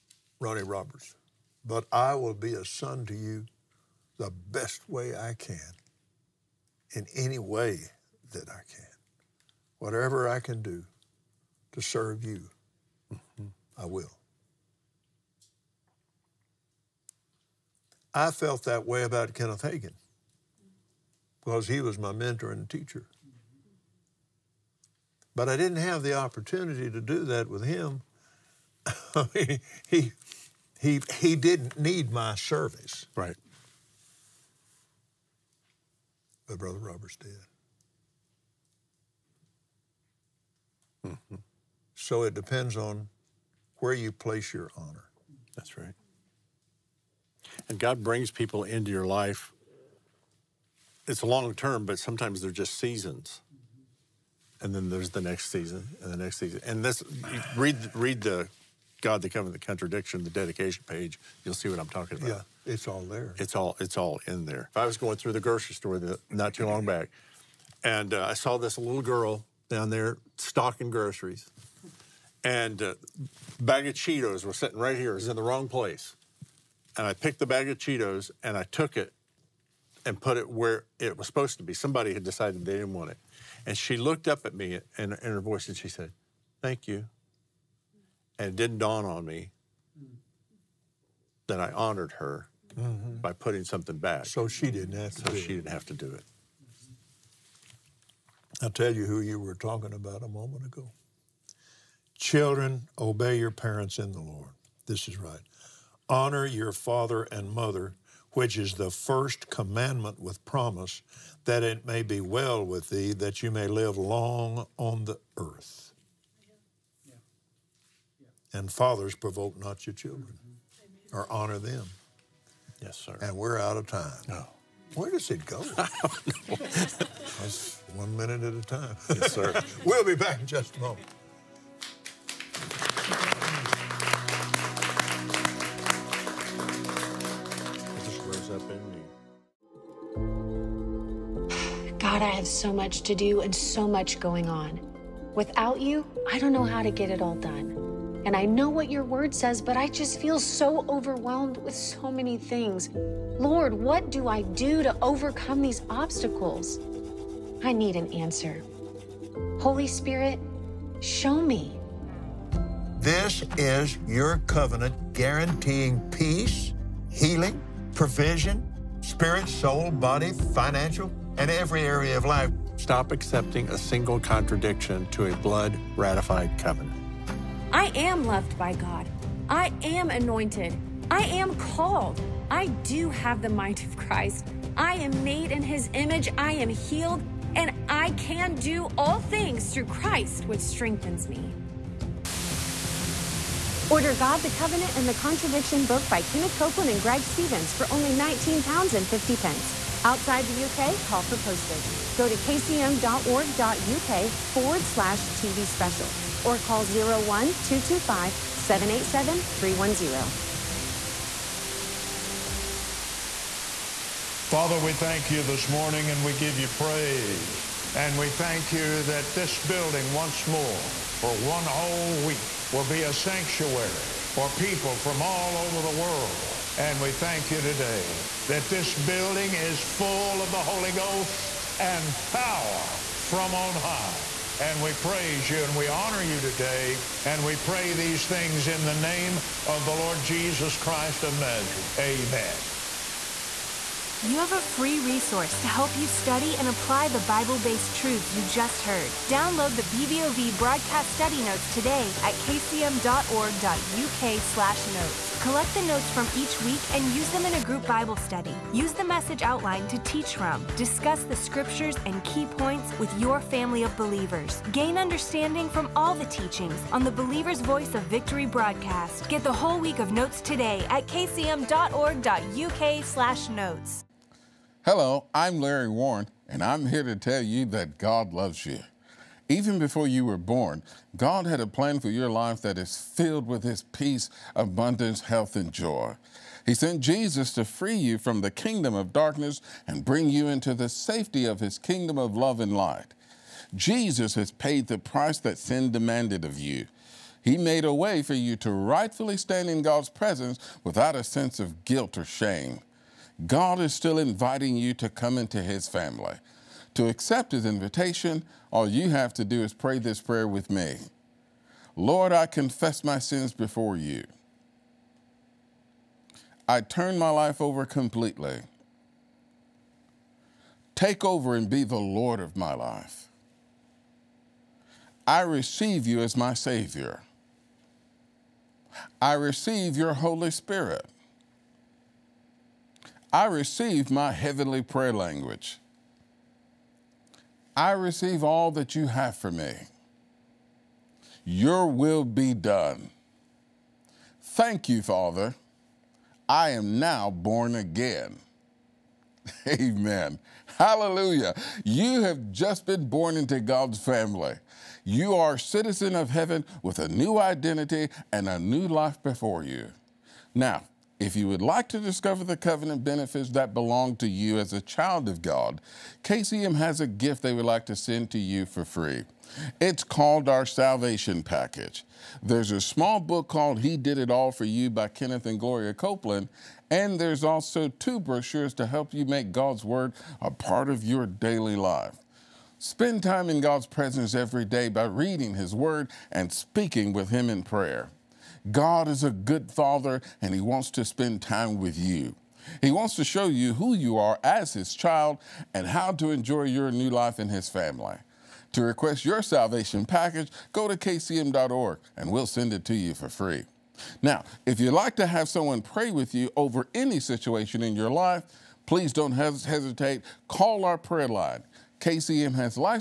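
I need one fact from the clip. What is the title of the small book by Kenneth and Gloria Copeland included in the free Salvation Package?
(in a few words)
He Did It All for You.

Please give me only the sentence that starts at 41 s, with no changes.
So it depends on where you place your honor.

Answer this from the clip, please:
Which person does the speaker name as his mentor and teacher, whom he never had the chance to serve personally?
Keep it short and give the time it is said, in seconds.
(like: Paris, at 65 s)
Kenneth Hagin, at 19 s.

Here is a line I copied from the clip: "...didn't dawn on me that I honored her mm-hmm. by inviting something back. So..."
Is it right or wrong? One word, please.
wrong.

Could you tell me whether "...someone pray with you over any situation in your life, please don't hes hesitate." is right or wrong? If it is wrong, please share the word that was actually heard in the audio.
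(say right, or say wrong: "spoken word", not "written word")
right.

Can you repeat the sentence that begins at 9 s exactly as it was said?
Whatever I can do to serve you, mm-hmm.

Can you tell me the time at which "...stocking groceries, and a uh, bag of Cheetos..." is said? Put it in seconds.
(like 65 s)
70 s.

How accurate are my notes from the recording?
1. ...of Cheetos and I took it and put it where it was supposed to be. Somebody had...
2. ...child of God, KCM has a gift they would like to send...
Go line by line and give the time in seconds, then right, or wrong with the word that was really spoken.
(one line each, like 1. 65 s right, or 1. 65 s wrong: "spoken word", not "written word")
1. 77 s right
2. 364 s right.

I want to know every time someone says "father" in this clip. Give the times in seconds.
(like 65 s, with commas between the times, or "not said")
106 s, 118 s, 214 s, 345 s, 389 s.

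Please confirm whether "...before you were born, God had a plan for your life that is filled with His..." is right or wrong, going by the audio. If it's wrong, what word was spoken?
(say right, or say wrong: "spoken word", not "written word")
right.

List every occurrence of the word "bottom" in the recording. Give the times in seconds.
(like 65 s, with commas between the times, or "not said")
not said.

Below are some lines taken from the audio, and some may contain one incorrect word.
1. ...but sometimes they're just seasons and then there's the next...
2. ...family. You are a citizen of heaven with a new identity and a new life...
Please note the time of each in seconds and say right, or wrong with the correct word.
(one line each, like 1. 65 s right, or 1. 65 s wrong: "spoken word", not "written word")
1. 51 s right
2. 353 s right.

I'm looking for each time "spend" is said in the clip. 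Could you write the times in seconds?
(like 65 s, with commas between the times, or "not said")
382 s, 391 s.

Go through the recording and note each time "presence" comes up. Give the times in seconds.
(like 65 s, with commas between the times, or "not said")
300 s, 383 s.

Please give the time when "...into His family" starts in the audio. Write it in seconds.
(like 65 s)
305 s.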